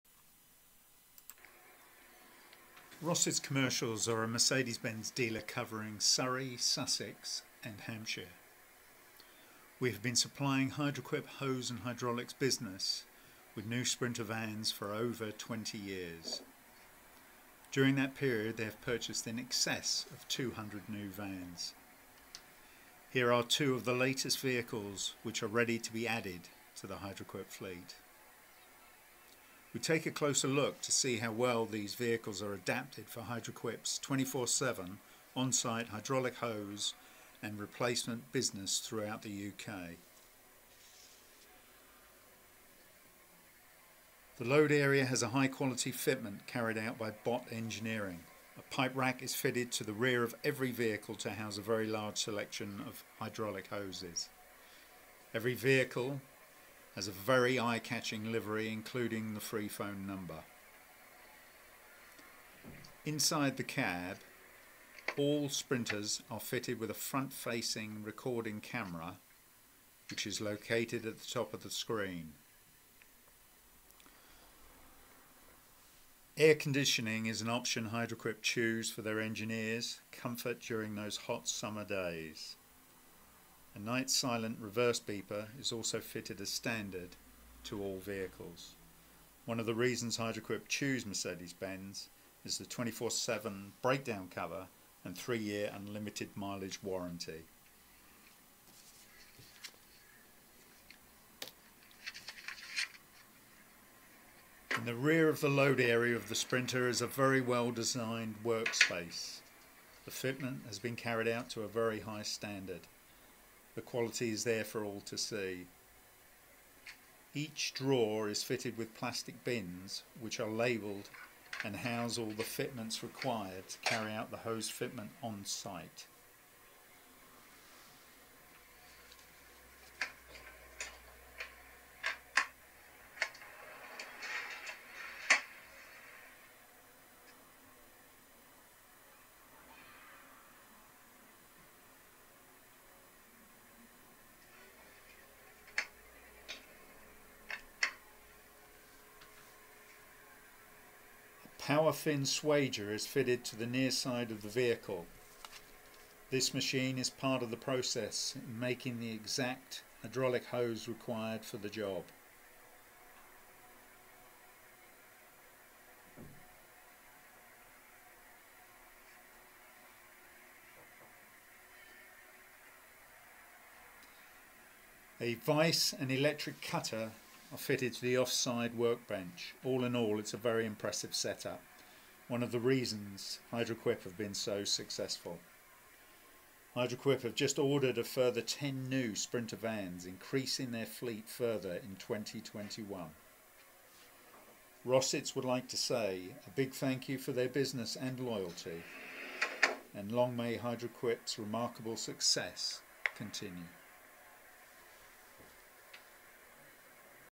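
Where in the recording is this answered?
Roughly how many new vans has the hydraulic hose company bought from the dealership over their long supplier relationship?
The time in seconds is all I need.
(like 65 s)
20 s.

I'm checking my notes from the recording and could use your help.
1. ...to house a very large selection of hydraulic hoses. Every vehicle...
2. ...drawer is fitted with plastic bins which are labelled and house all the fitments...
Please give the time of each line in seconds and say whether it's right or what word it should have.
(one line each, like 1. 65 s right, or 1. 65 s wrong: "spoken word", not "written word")
1. 51 s right
2. 117 s right.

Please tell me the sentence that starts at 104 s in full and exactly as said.
In the rear of the load area of the Sprinter is a very well designed workspace.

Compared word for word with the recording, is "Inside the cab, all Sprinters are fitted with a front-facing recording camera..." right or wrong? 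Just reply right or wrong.
right.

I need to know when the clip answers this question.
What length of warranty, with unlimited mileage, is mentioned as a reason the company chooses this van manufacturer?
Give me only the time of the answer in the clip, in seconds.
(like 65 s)
95 s.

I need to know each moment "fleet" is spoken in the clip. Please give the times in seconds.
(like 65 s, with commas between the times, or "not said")
27 s, 190 s.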